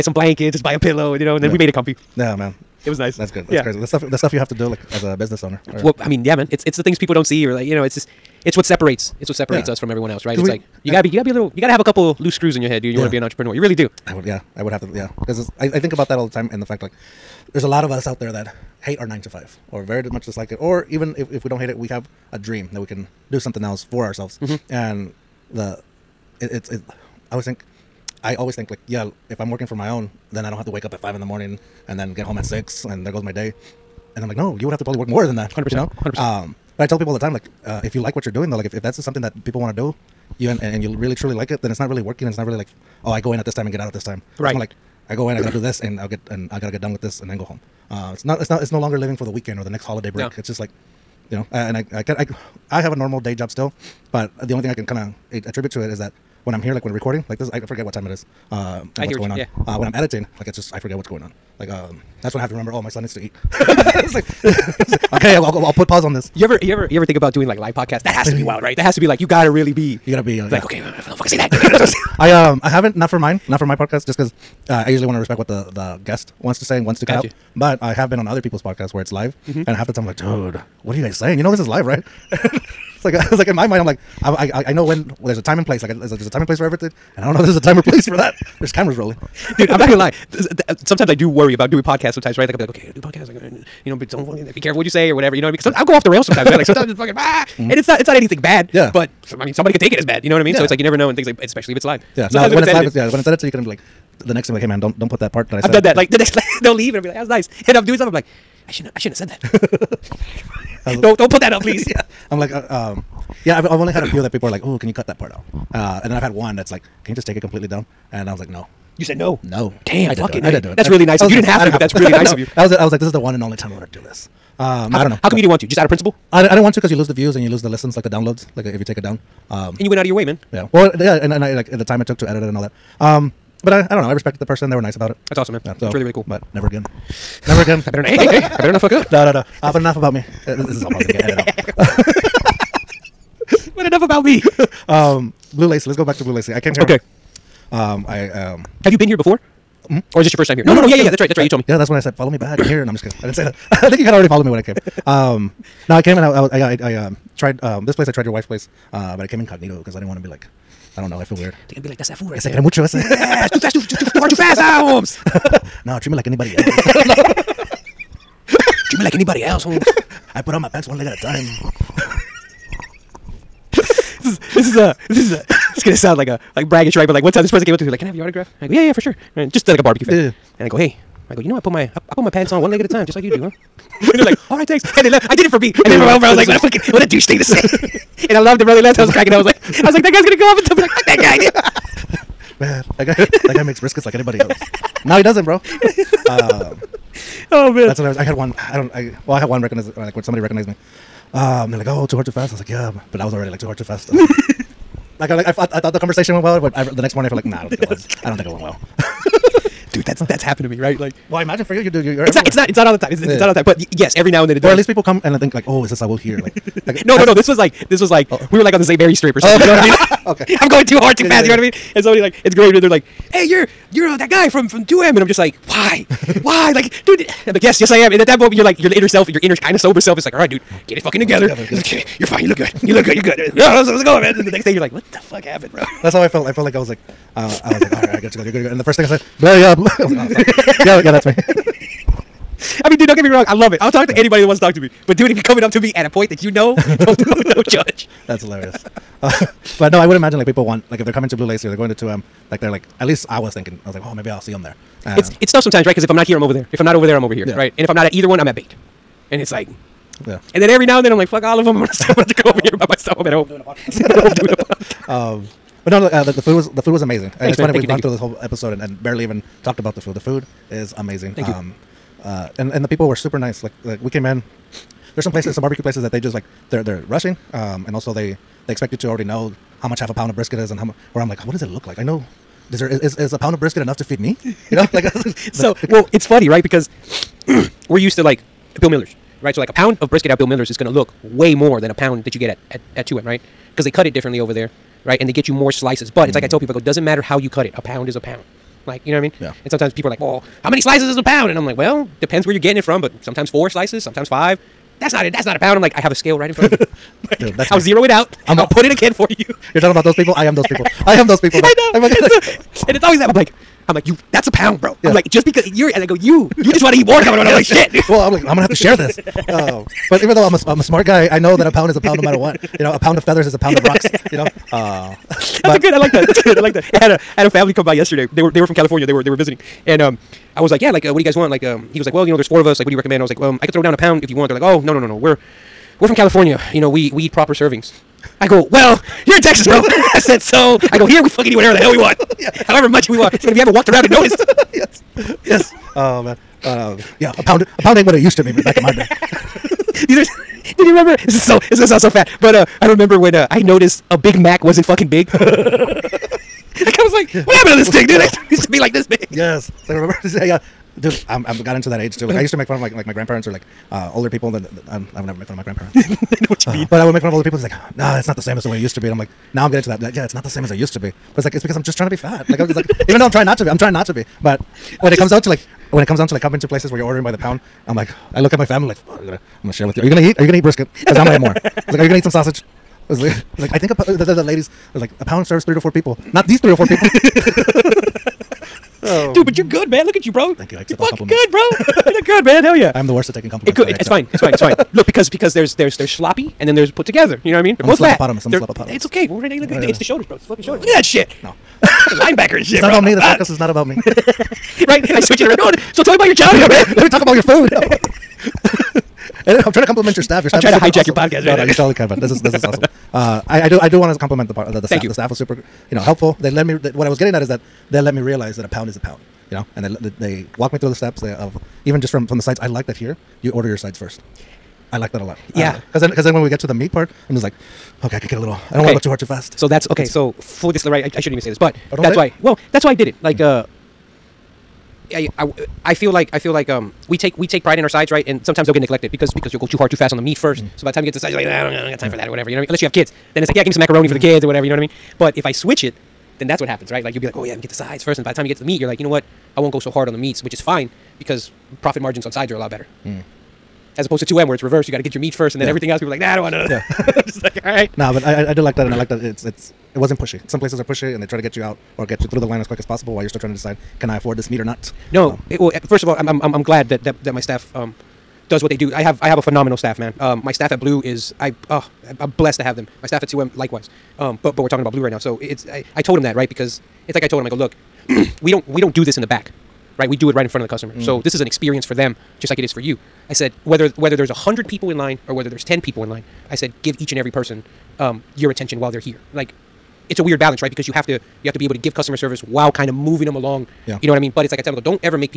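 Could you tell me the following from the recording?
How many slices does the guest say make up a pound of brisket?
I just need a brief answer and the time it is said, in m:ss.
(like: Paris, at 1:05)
4 or 5, at 5:03.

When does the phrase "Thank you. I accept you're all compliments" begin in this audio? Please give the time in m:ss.
6:30.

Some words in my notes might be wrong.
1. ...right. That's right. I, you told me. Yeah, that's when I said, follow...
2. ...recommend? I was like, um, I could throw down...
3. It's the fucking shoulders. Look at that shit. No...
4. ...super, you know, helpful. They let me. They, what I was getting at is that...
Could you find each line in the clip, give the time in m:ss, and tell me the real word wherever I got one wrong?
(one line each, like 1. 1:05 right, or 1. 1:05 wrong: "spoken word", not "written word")
1. 2:31 right
2. 5:32 right
3. 6:40 right
4. 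6:55 right.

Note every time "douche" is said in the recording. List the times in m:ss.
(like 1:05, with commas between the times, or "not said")
3:07.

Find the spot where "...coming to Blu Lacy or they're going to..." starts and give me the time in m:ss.
4:11.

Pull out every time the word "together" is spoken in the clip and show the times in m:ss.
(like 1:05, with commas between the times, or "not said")
3:51, 6:37.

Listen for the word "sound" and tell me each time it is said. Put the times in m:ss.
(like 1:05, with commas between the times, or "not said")
2:55, 5:51.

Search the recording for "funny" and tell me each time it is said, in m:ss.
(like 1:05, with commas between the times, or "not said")
4:27, 4:46.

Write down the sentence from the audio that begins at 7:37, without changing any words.
Nah, but I, I, I did like that, and I like that it's it's it wasn't pushy.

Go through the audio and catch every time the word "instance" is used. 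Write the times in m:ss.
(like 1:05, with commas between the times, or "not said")
not said.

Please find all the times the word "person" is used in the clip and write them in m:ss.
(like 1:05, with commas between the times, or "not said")
2:14, 2:57, 8:07.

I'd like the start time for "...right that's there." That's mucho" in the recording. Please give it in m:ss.
2:42.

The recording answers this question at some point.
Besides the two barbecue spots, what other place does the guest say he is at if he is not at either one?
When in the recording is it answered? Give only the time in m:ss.
4:18.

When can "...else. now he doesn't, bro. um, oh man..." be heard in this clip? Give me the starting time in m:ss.
3:14.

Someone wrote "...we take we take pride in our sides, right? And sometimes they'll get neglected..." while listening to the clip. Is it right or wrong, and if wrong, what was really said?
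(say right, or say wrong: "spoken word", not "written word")
right.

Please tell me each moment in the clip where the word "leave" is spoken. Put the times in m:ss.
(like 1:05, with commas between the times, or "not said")
1:46.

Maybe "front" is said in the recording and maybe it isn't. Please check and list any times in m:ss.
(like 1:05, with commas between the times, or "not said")
5:06, 8:00.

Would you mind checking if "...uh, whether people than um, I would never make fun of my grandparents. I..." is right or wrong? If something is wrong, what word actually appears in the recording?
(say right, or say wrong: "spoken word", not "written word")
wrong: "older", not "whether".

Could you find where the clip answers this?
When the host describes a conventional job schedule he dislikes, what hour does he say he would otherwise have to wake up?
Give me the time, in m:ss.
0:30.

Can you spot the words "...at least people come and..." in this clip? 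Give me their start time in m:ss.
3:34.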